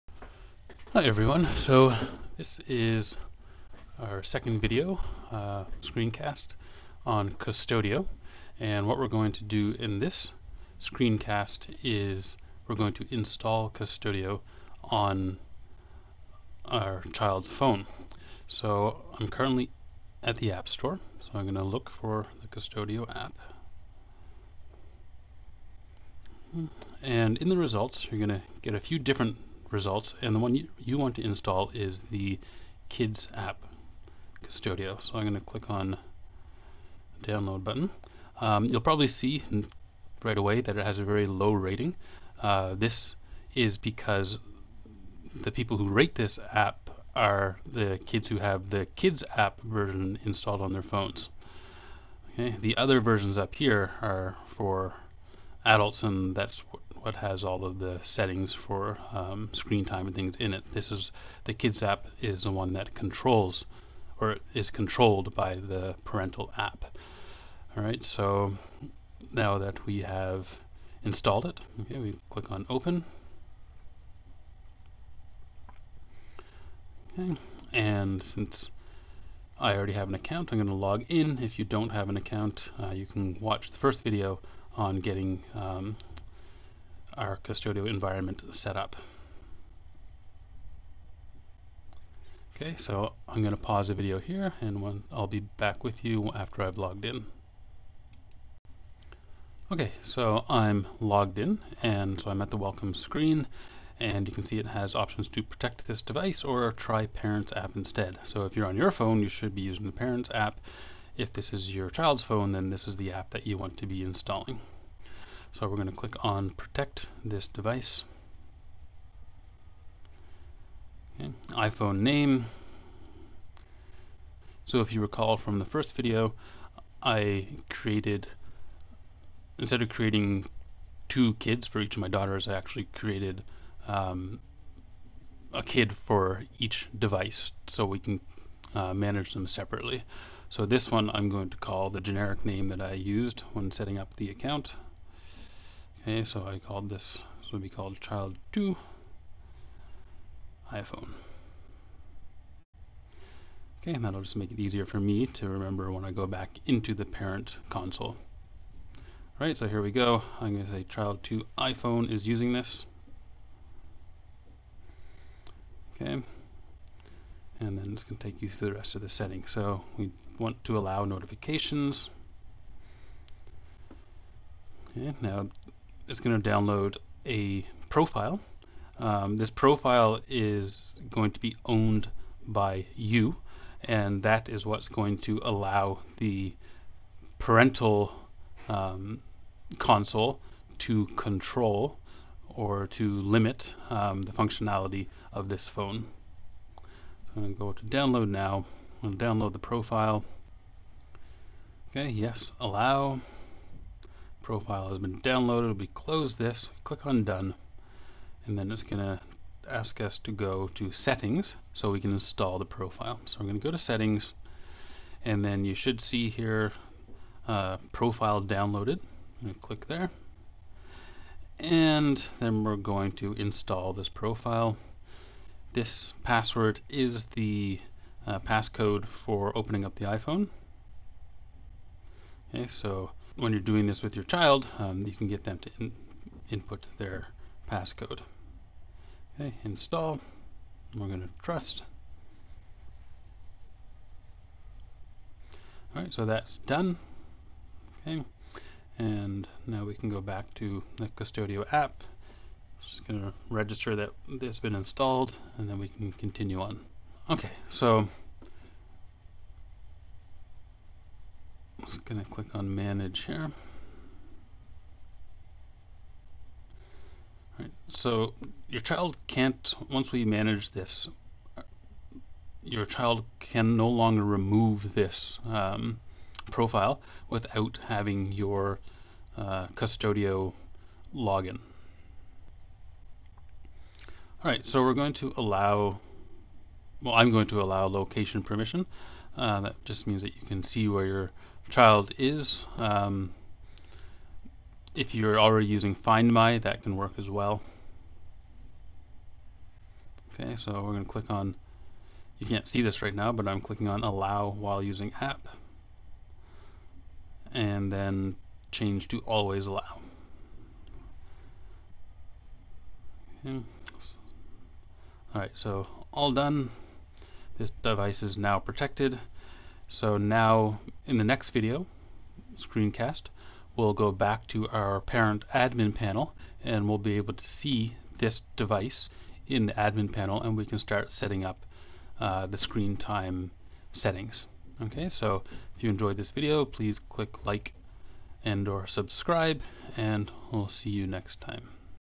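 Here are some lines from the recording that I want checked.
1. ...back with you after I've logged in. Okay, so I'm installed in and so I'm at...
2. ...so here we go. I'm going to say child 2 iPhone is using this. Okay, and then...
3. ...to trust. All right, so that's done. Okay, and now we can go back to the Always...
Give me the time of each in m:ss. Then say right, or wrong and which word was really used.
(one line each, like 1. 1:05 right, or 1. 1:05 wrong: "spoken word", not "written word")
1. 1:35 wrong: "logged", not "installed"
2. 2:39 right
3. 4:01 wrong: "Qustodio", not "Always".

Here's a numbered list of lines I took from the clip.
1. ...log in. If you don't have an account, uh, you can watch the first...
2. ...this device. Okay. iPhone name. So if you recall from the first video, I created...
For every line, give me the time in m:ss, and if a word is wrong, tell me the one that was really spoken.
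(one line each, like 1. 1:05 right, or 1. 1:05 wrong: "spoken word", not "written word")
1. 1:20 right
2. 1:57 right.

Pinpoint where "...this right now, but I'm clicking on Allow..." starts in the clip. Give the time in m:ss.
5:02.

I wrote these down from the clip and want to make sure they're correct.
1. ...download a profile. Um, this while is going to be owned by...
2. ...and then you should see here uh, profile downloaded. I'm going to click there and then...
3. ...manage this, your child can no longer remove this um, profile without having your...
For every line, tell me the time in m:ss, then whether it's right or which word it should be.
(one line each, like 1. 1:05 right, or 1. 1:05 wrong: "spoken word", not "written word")
1. 2:56 wrong: "profile", not "while"
2. 3:35 right
3. 4:30 right.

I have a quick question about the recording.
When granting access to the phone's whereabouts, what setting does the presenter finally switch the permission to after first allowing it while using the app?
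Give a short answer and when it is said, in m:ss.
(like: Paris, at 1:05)
Always Allow, at 5:09.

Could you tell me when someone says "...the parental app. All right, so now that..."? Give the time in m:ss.
1:05.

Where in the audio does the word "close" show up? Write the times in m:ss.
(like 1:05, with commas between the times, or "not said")
3:25.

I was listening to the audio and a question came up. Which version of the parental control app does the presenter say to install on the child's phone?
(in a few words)
Kids app Qustodio.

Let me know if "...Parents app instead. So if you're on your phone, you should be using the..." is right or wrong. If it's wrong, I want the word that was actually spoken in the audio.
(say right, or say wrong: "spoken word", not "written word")
right.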